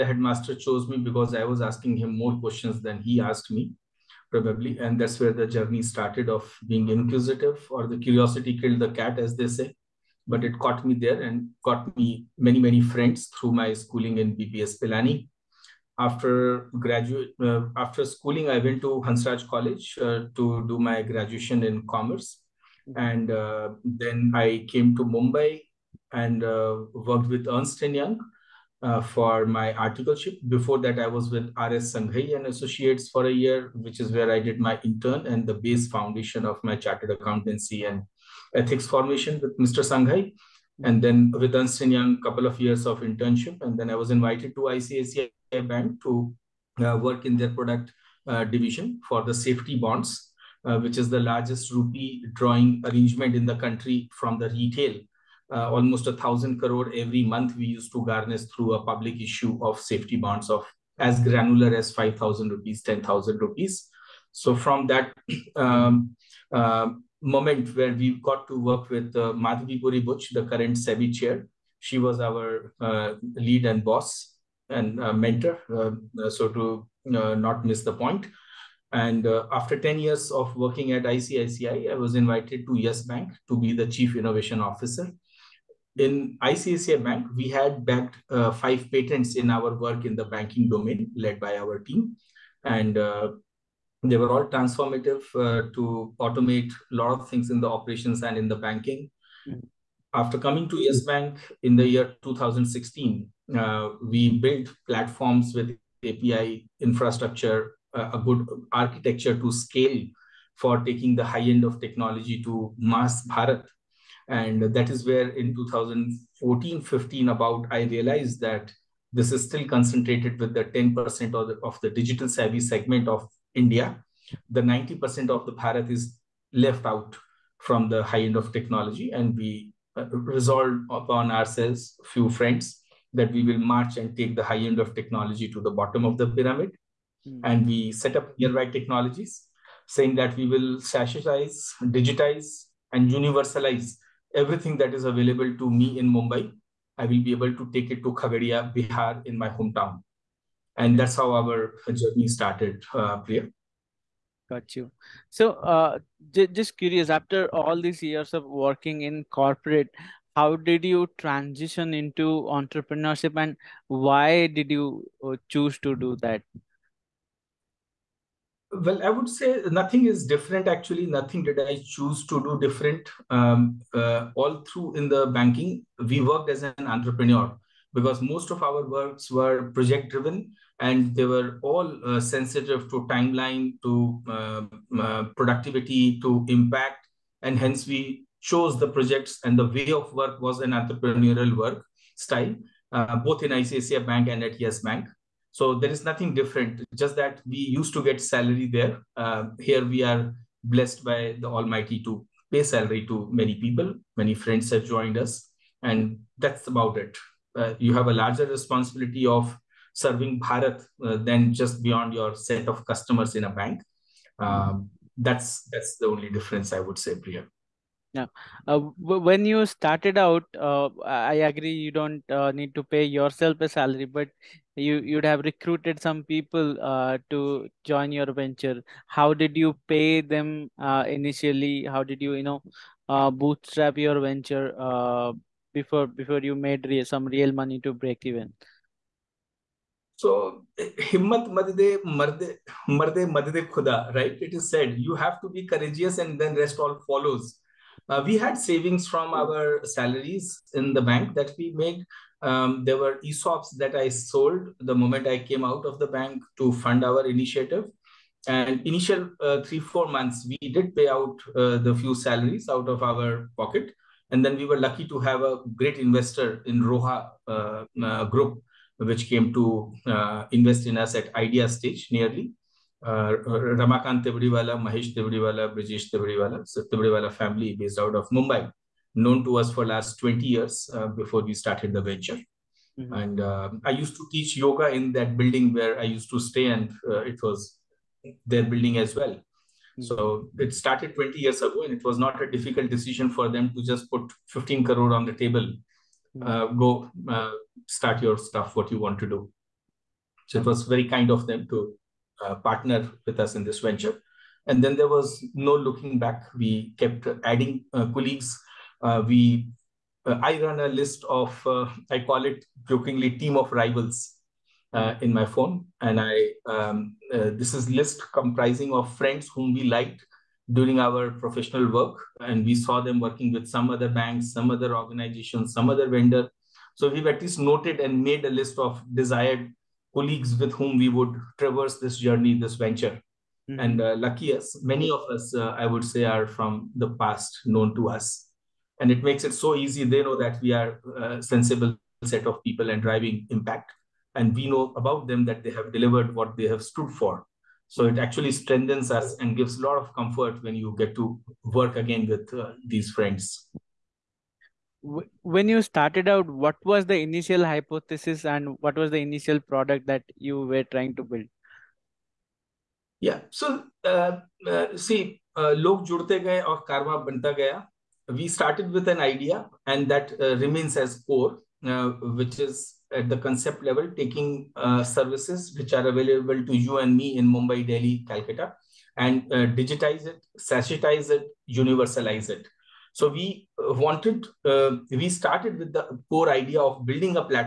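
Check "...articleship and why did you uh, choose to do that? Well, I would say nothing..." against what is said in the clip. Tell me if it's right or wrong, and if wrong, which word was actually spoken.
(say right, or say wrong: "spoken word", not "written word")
wrong: "entrepreneurship", not "articleship".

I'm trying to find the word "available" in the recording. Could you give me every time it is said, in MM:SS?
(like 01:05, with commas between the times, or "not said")
02:25, 06:16.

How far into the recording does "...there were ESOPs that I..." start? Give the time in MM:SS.
04:12.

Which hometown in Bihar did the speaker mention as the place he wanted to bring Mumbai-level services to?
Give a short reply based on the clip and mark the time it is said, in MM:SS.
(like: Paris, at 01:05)
Khagaria, at 02:28.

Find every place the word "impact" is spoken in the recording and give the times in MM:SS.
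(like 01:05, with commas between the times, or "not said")
03:06, 05:43.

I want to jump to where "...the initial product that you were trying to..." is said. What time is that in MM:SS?
05:59.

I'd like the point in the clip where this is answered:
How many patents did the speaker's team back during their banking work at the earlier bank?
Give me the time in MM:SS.
01:28.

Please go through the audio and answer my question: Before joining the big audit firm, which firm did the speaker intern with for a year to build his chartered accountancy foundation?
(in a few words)
R.S. Sanghai and Associates.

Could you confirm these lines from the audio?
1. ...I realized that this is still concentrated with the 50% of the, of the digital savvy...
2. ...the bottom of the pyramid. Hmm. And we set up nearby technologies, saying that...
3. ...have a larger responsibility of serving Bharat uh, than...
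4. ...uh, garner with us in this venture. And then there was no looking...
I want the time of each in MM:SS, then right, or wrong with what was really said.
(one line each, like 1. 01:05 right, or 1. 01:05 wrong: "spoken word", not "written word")
1. 01:57 wrong: "10", not "50"
2. 02:15 right
3. 03:27 right
4. 05:02 wrong: "partner", not "garner".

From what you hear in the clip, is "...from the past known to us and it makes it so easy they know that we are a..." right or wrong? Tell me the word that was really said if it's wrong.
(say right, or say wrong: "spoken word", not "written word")
right.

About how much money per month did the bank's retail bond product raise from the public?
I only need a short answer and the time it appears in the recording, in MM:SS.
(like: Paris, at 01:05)
1,000 crore, at 00:56.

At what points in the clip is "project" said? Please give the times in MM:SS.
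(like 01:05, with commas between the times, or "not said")
02:59, 03:08.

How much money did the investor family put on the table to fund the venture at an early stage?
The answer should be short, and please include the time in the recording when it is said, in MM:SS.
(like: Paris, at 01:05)
15 crore, at 04:54.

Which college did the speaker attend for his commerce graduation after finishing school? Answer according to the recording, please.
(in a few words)
Hansraj College.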